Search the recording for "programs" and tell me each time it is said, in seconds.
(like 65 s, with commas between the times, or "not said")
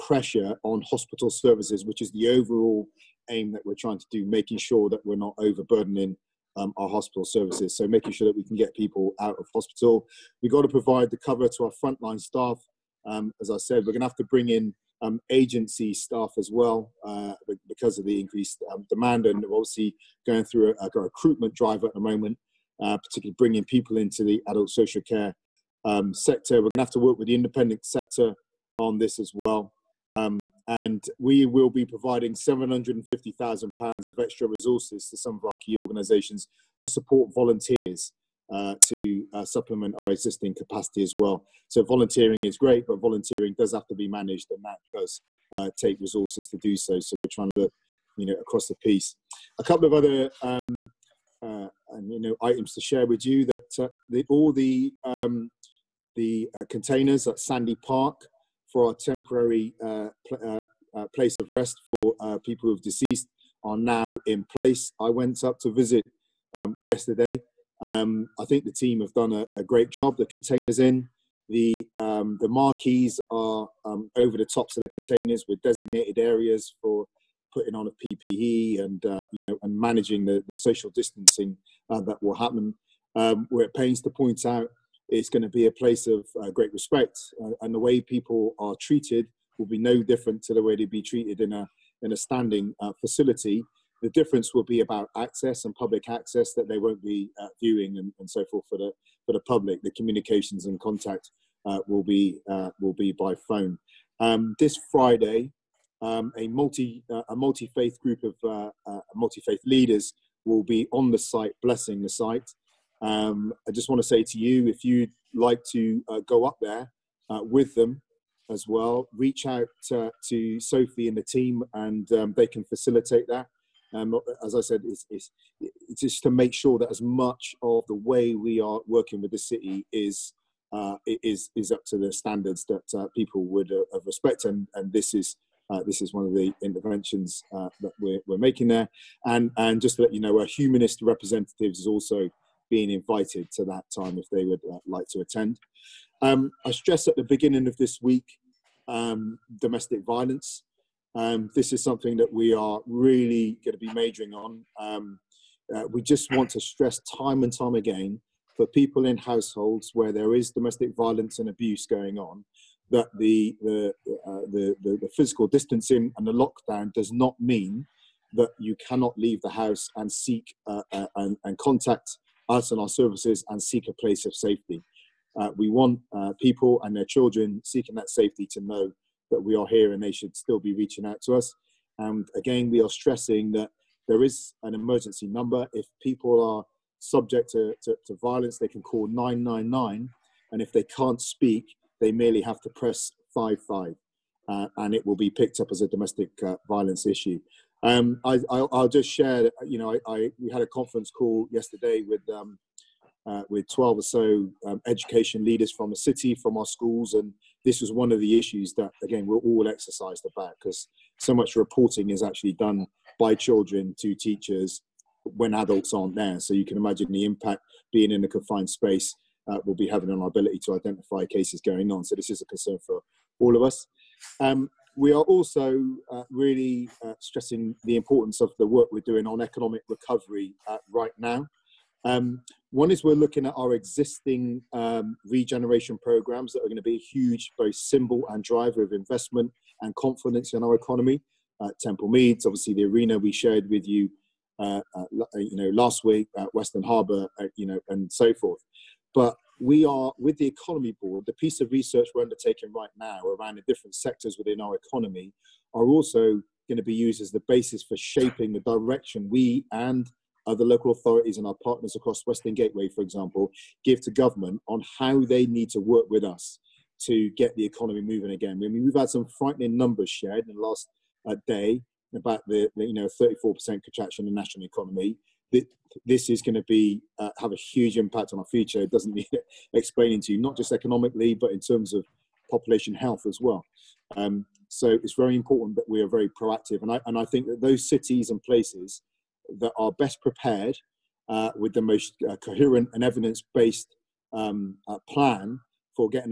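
236 s.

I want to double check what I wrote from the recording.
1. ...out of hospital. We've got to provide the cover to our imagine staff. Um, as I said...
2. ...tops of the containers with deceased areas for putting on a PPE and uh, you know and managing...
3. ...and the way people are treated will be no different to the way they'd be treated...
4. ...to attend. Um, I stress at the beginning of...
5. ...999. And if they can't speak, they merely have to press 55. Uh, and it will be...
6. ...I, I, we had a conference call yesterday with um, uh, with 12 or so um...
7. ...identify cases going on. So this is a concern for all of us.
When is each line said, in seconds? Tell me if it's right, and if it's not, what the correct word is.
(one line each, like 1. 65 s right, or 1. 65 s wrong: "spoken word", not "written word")
1. 9 s wrong: "frontline", not "imagine"
2. 74 s wrong: "designated", not "deceased"
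3. 87 s right
4. 145 s right
5. 189 s right
6. 199 s right
7. 220 s right.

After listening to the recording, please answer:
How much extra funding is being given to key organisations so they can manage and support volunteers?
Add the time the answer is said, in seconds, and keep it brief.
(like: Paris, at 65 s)
£750,000, at 32 s.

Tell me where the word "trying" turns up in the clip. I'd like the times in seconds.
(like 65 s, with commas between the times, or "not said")
3 s, 47 s.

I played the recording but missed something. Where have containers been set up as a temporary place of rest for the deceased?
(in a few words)
Sandy Park.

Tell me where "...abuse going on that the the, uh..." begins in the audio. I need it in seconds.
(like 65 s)
161 s.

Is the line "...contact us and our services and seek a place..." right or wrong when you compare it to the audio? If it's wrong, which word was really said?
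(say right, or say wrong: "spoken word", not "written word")
right.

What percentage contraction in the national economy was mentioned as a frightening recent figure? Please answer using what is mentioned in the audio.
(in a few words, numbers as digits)
34%.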